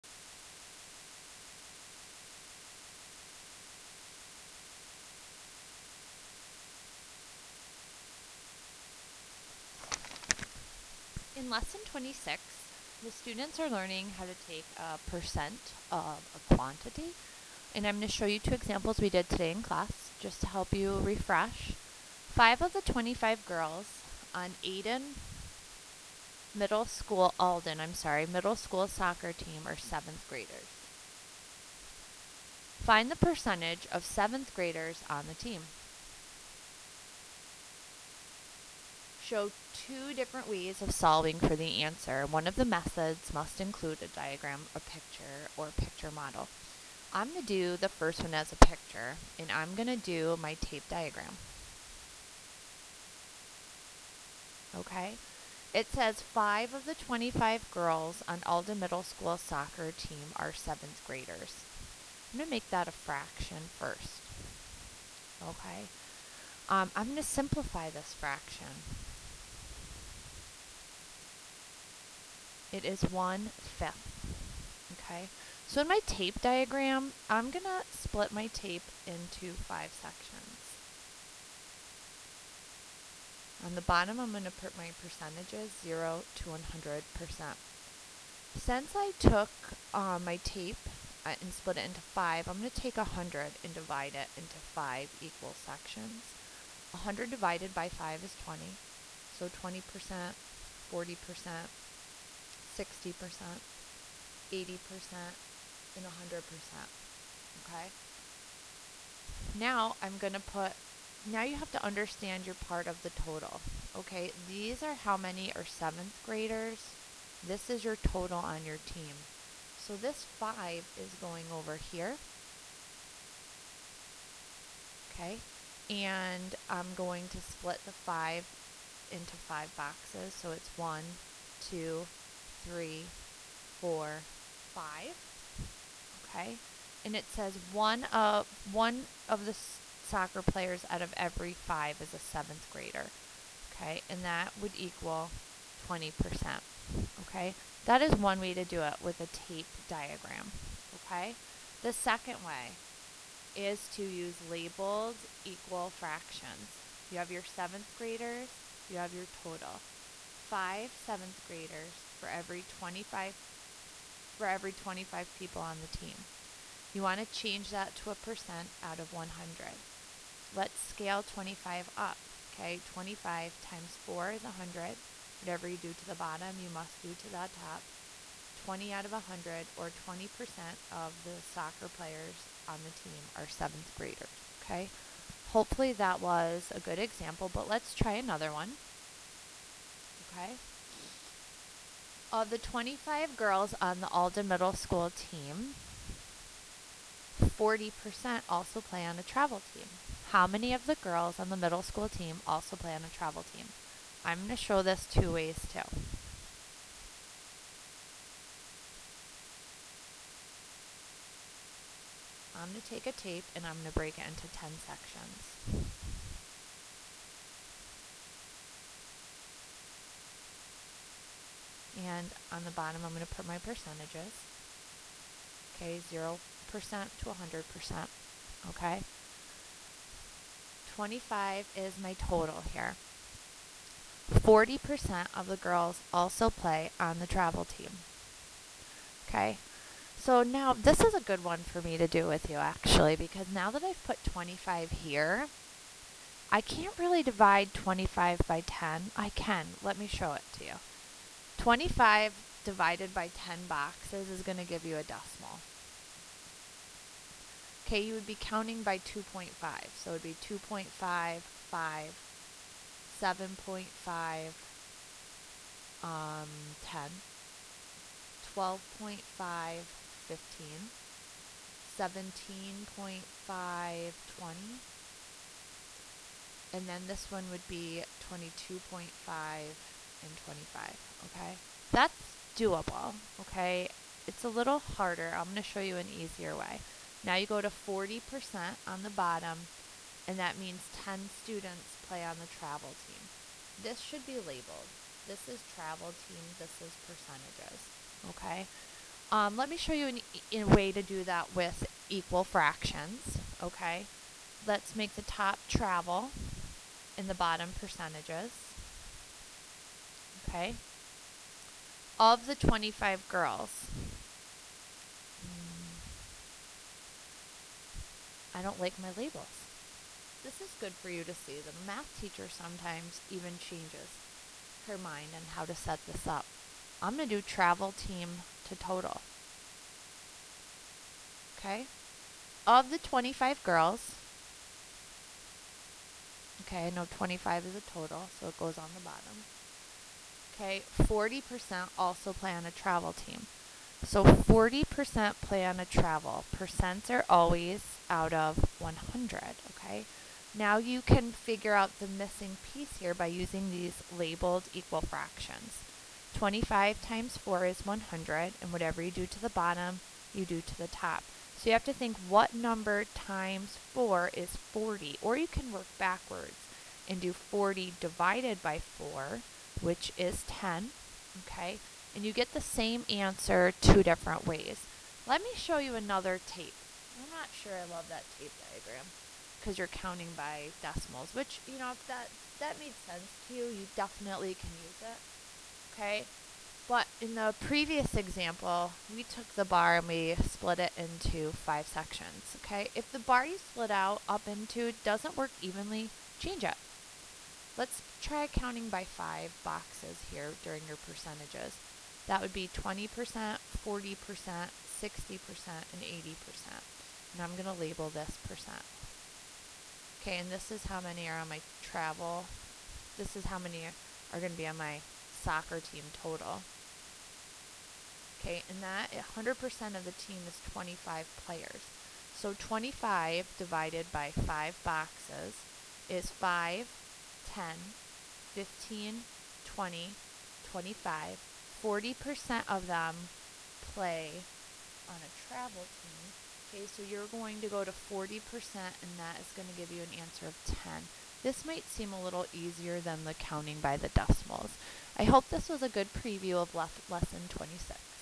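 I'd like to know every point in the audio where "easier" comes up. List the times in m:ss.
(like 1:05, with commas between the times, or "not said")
4:46, 7:22.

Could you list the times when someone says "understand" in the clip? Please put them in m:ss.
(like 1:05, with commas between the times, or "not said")
1:51.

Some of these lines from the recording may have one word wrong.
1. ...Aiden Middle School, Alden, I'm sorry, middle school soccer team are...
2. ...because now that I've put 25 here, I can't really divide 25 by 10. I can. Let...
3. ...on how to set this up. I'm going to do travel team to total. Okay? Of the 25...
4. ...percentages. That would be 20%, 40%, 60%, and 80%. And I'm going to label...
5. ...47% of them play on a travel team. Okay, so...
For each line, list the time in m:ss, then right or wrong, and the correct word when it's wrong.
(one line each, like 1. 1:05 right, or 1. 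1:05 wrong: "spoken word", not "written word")
1. 0:24 right
2. 4:03 right
3. 5:25 right
4. 6:41 right
5. 7:11 wrong: "40", not "47".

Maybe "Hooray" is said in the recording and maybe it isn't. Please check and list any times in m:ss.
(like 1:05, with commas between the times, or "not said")
not said.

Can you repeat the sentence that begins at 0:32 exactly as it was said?
Find the percentage of seventh graders on the team.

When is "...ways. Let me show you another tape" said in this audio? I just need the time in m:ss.
6:14.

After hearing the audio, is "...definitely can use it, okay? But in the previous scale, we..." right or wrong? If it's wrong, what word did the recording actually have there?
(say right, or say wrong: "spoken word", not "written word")
wrong: "example", not "scale".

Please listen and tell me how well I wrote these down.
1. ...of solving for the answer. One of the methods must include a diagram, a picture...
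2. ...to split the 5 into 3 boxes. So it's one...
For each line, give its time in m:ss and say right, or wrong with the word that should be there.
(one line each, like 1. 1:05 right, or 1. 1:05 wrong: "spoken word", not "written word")
1. 0:40 right
2. 2:07 wrong: "5", not "3".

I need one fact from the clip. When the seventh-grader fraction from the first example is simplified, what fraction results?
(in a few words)
One-fifth.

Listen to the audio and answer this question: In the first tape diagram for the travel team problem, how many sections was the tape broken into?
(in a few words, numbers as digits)
10.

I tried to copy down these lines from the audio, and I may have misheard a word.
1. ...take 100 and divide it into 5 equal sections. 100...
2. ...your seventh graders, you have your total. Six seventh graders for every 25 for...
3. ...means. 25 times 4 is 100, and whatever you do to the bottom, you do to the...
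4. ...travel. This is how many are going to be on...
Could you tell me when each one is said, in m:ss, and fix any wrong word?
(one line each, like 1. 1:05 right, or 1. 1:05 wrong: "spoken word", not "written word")
1. 1:32 right
2. 2:37 wrong: "Five", not "Six"
3. 5:55 wrong: "fractions", not "means"
4. 6:51 right.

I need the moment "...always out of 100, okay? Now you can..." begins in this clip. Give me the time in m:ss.
5:47.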